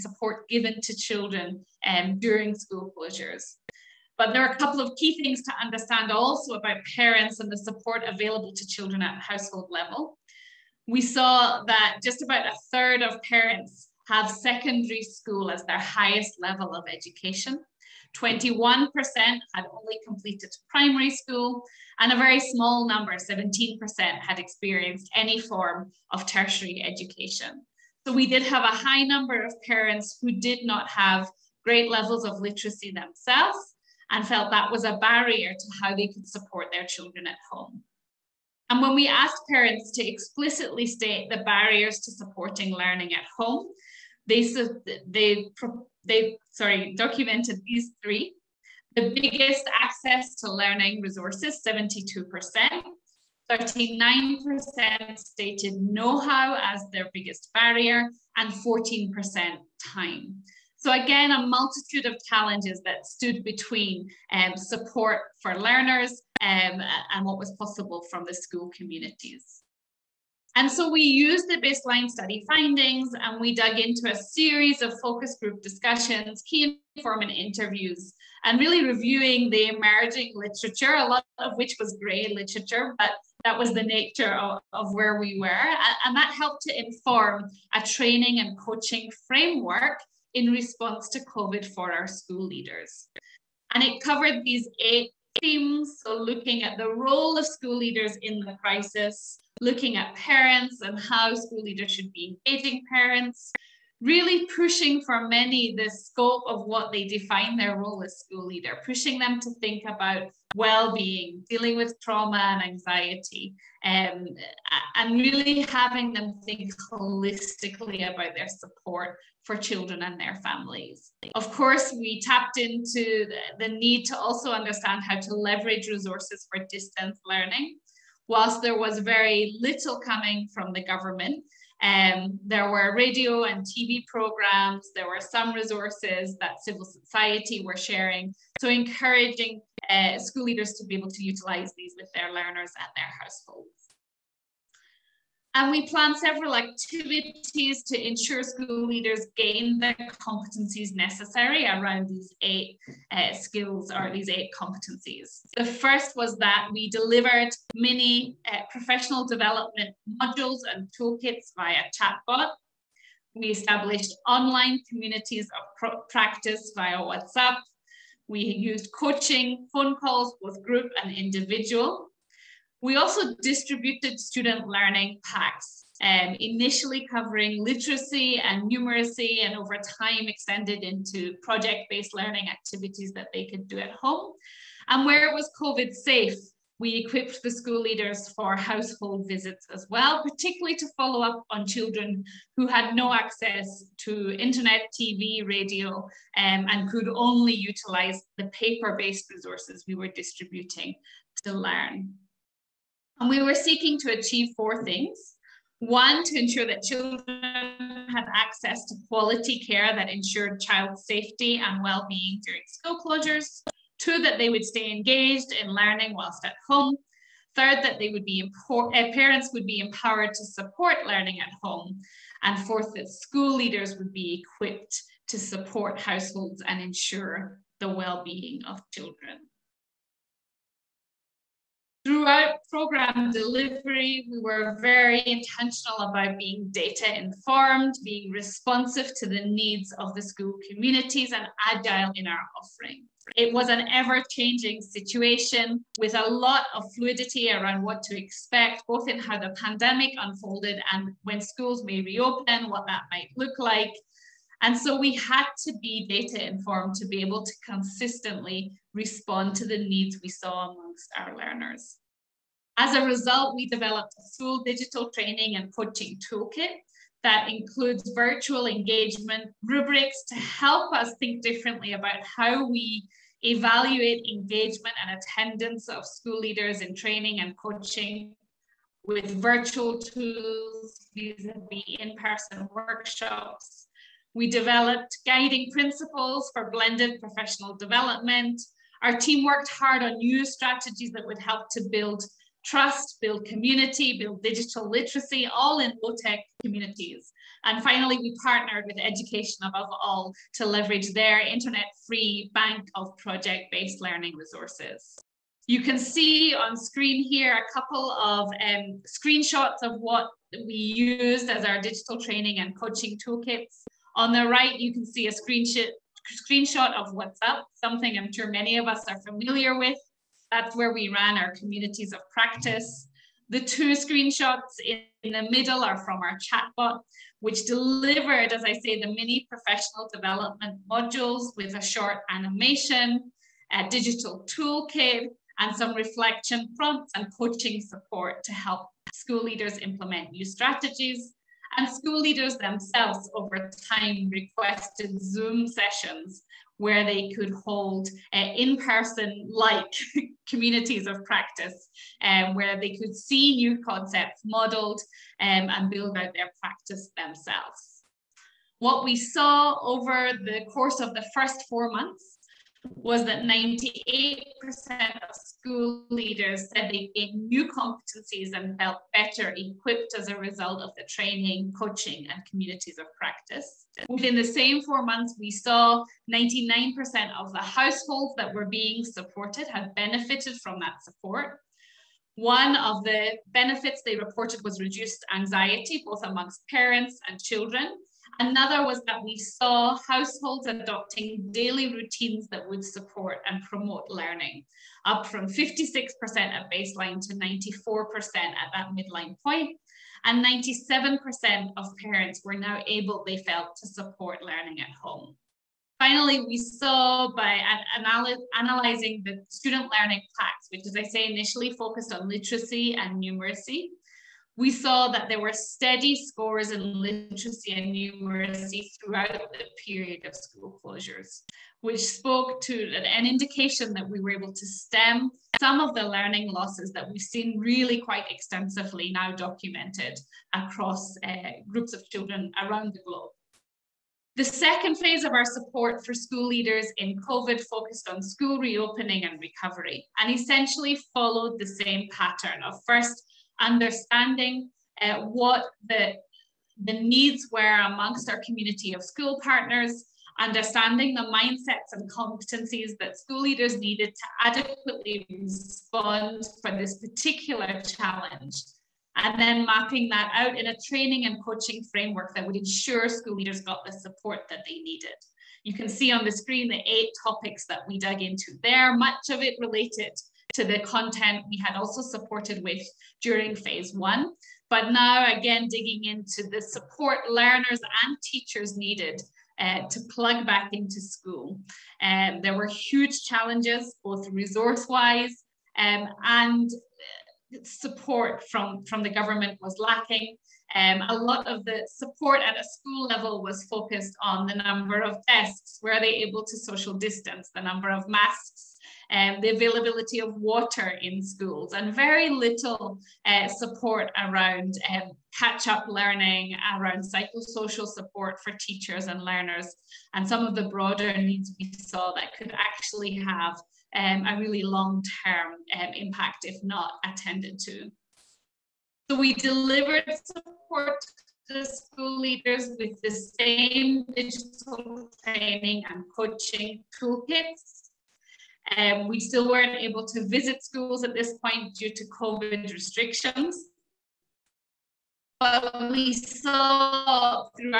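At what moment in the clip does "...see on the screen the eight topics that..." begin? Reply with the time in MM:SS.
07:45.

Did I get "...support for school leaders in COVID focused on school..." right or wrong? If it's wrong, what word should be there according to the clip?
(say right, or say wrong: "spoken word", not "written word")
right.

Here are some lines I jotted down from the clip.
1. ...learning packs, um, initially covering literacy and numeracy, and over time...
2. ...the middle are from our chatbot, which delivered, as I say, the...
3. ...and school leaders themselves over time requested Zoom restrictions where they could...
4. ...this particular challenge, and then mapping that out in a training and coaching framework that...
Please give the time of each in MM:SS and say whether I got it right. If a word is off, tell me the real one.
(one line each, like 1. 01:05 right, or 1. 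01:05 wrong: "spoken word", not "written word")
1. 02:54 right
2. 05:25 right
3. 05:41 wrong: "sessions", not "restrictions"
4. 07:36 right.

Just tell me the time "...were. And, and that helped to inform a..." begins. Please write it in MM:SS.
01:25.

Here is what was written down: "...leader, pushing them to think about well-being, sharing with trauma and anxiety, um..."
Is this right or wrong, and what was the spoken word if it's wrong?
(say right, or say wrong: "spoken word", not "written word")
wrong: "dealing", not "sharing".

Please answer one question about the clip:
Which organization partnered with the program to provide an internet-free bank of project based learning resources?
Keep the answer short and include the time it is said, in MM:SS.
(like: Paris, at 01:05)
Education Above All, at 04:59.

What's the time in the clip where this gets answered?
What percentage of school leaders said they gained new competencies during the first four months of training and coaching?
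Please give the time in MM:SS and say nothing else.
06:03.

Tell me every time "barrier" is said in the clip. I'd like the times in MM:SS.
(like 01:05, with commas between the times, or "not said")
00:34, 00:41, 00:57.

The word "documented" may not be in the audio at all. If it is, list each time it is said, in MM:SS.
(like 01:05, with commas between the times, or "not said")
00:46, 07:09.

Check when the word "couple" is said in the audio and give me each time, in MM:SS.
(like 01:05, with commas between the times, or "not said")
00:04, 05:07.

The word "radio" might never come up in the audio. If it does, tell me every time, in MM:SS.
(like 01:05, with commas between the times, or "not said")
02:12, 03:15.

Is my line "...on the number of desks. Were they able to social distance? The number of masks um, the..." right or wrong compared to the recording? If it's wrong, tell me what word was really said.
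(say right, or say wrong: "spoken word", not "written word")
right.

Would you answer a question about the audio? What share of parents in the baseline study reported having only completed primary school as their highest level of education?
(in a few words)
21%.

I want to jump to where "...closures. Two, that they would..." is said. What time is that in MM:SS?
03:32.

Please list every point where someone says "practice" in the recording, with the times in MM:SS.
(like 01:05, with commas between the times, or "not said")
02:46, 05:22, 05:51, 05:56, 06:13.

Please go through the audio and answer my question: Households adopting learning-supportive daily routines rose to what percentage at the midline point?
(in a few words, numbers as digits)
94%.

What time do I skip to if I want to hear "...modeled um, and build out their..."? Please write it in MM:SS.
05:54.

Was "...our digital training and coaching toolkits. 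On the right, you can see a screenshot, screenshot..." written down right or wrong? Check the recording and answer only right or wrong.
right.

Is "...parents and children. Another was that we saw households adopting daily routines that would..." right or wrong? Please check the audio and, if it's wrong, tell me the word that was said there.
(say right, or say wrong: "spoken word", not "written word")
right.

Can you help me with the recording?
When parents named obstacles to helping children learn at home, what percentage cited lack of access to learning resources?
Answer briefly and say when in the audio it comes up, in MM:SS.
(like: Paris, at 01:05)
72%, at 00:51.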